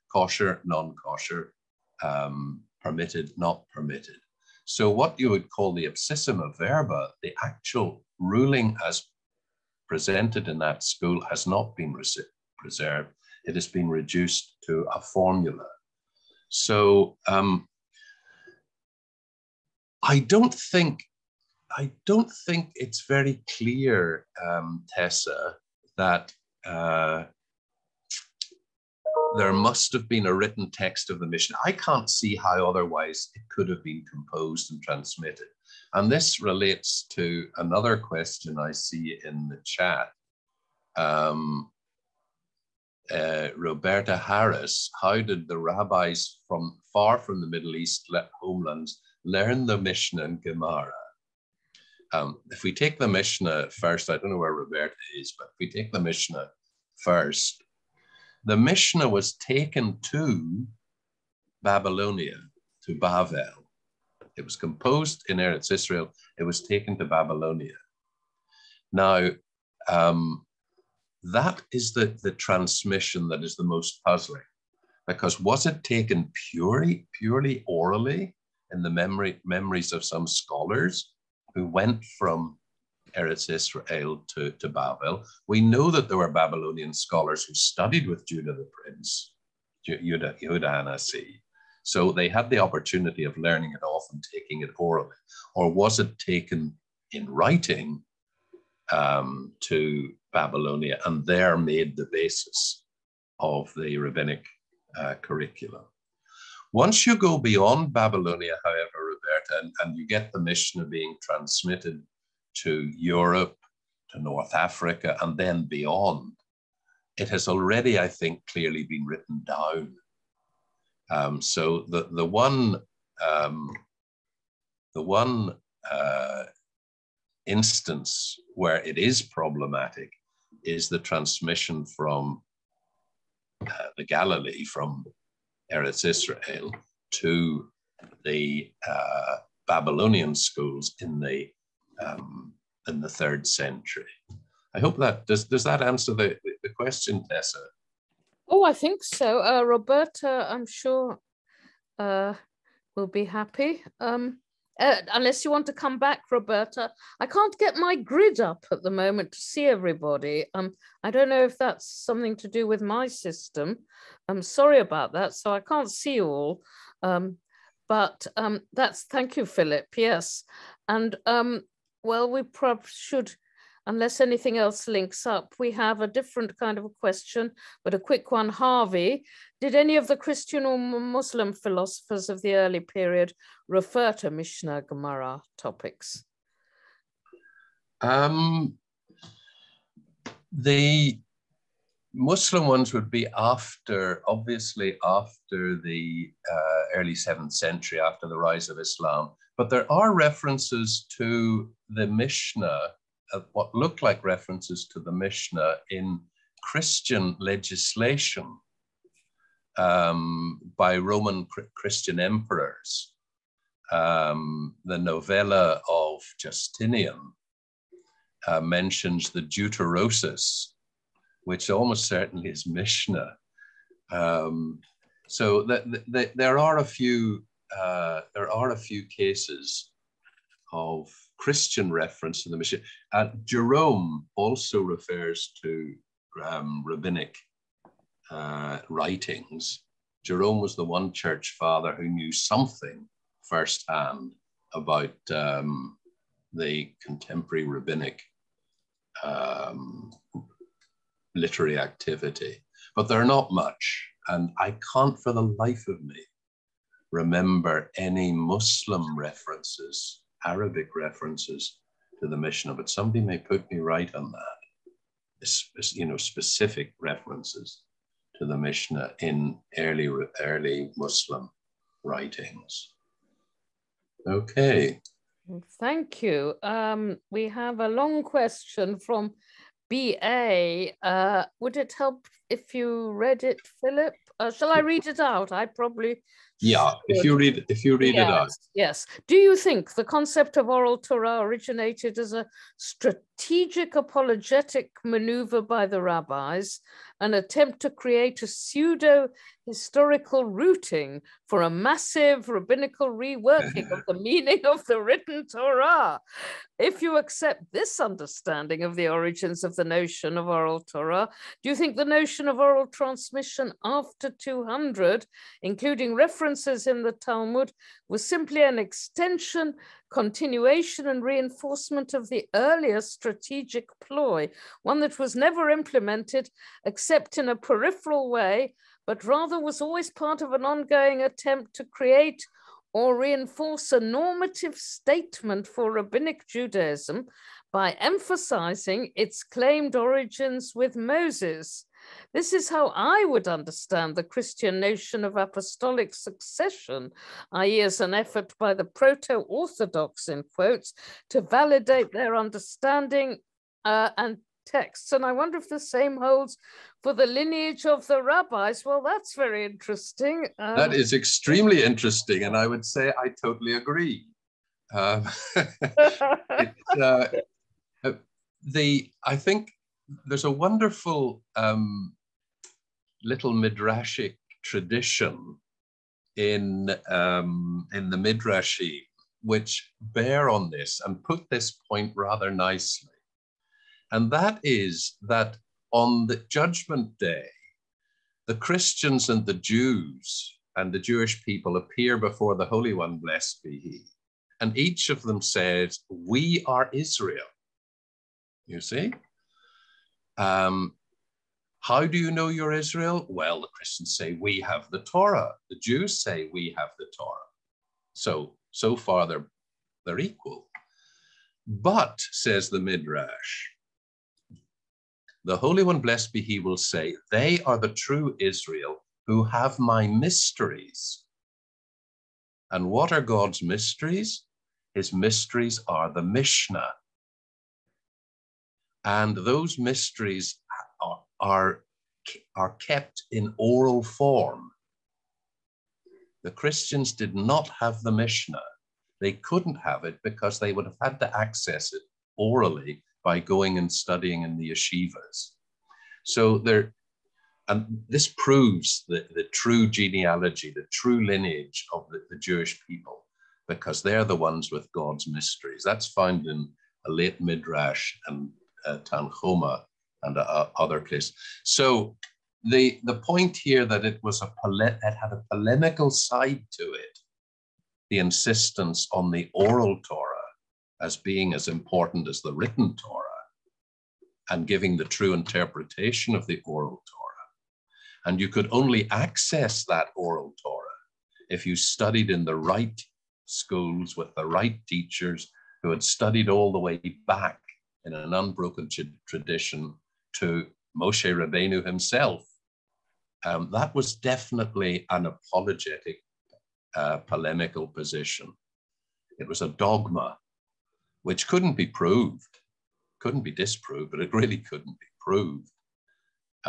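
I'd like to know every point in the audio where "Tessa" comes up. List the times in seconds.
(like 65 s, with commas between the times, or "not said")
24 s, 147 s.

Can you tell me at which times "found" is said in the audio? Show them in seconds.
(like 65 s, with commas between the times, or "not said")
456 s.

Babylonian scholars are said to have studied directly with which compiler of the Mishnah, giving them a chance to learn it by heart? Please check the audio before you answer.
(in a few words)
Judah the prince.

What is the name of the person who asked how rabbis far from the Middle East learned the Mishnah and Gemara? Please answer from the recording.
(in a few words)
Roberta Harris.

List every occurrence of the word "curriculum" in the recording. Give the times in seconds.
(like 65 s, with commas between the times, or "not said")
105 s.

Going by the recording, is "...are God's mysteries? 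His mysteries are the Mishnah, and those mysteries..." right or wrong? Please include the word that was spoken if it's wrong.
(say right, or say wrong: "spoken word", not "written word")
right.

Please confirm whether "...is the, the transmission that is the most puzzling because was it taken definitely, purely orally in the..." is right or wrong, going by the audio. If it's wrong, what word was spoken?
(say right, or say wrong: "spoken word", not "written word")
wrong: "purely", not "definitely".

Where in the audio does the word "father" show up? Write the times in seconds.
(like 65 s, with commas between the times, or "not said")
241 s.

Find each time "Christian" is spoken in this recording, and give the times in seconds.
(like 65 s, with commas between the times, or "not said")
180 s, 206 s, 211 s, 231 s, 344 s, 388 s, 403 s, 436 s.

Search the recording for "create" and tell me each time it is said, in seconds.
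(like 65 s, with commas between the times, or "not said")
297 s, 331 s.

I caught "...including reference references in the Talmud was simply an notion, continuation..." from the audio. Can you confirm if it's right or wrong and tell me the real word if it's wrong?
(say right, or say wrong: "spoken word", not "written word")
wrong: "extension", not "notion".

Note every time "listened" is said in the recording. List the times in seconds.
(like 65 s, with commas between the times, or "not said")
not said.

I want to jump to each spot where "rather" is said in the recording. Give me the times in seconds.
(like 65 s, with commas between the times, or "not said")
329 s, 382 s.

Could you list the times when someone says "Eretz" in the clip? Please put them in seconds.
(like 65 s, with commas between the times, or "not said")
65 s, 83 s, 135 s.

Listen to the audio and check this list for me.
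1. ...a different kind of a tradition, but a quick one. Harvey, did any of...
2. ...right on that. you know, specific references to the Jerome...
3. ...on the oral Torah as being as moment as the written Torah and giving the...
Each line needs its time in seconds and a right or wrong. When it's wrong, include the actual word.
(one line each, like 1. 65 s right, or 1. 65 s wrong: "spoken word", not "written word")
1. 175 s wrong: "question", not "tradition"
2. 263 s wrong: "Mishnah", not "Jerome"
3. 469 s wrong: "important", not "moment".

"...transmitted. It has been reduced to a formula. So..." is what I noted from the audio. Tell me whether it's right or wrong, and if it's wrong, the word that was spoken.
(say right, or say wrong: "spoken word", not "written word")
wrong: "preserved", not "transmitted".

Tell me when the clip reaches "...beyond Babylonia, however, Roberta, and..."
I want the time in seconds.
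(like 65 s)
107 s.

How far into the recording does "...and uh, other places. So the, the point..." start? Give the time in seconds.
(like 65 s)
460 s.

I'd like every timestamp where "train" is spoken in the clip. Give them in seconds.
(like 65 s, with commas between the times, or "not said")
not said.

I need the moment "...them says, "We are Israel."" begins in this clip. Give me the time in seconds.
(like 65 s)
395 s.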